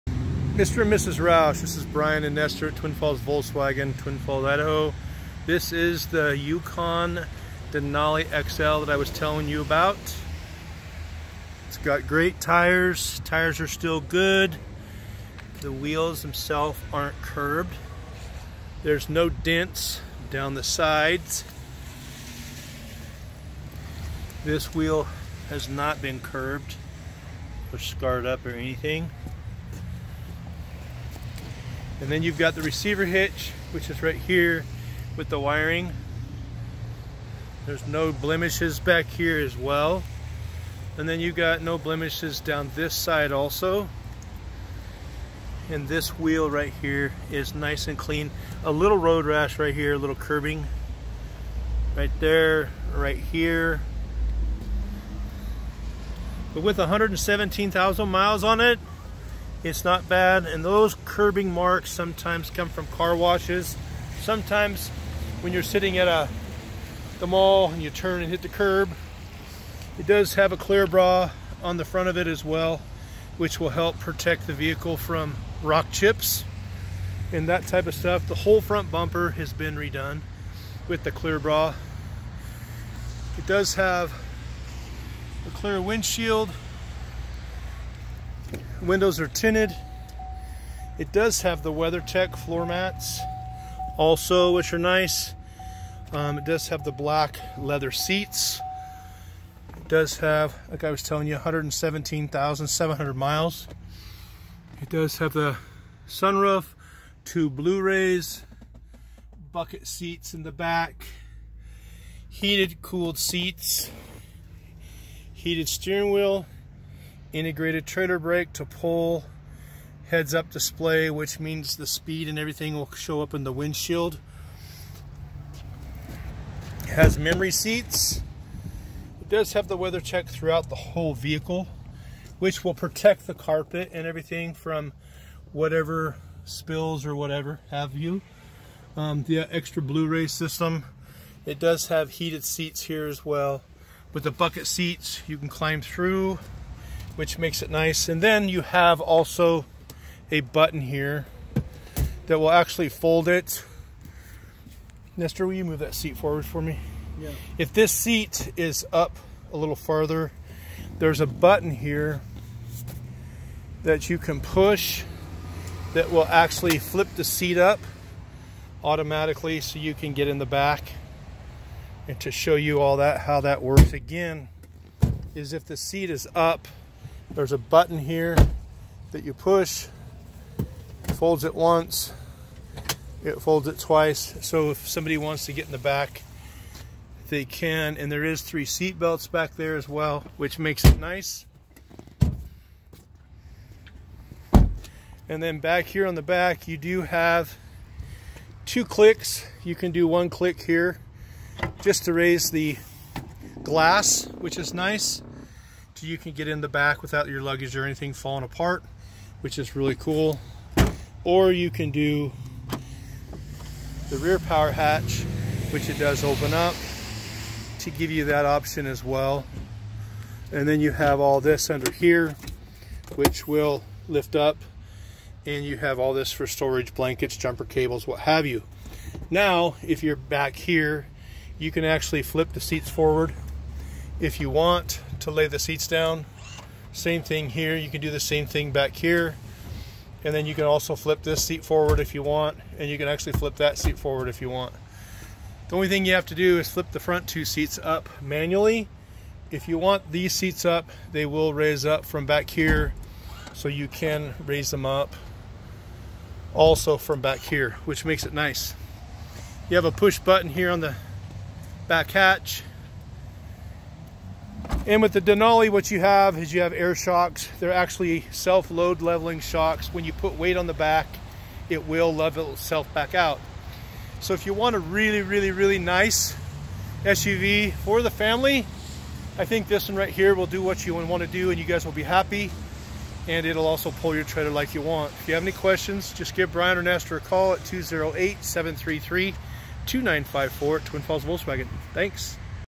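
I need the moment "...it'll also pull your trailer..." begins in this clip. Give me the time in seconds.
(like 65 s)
283 s.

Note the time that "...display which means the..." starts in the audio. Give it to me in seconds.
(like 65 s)
120 s.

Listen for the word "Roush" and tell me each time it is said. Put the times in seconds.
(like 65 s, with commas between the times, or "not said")
1 s.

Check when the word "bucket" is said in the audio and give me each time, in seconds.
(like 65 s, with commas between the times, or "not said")
109 s, 144 s.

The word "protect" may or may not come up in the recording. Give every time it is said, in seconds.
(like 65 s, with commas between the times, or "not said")
73 s, 132 s.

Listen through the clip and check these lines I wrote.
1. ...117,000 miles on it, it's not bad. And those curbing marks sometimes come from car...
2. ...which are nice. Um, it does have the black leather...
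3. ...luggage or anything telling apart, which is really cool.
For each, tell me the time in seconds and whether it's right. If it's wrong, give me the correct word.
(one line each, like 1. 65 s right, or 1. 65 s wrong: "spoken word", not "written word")
1. 56 s right
2. 94 s right
3. 207 s wrong: "falling", not "telling".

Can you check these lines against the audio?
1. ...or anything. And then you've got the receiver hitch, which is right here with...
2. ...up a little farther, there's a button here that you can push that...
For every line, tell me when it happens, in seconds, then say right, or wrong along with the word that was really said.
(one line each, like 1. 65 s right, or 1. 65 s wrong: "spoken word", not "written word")
1. 28 s right
2. 158 s right.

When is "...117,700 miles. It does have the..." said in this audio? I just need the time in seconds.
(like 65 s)
101 s.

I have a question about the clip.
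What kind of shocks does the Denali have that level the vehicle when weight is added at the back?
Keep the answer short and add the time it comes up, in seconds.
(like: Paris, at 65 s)
Air shocks, at 266 s.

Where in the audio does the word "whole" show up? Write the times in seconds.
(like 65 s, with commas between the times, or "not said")
78 s, 130 s.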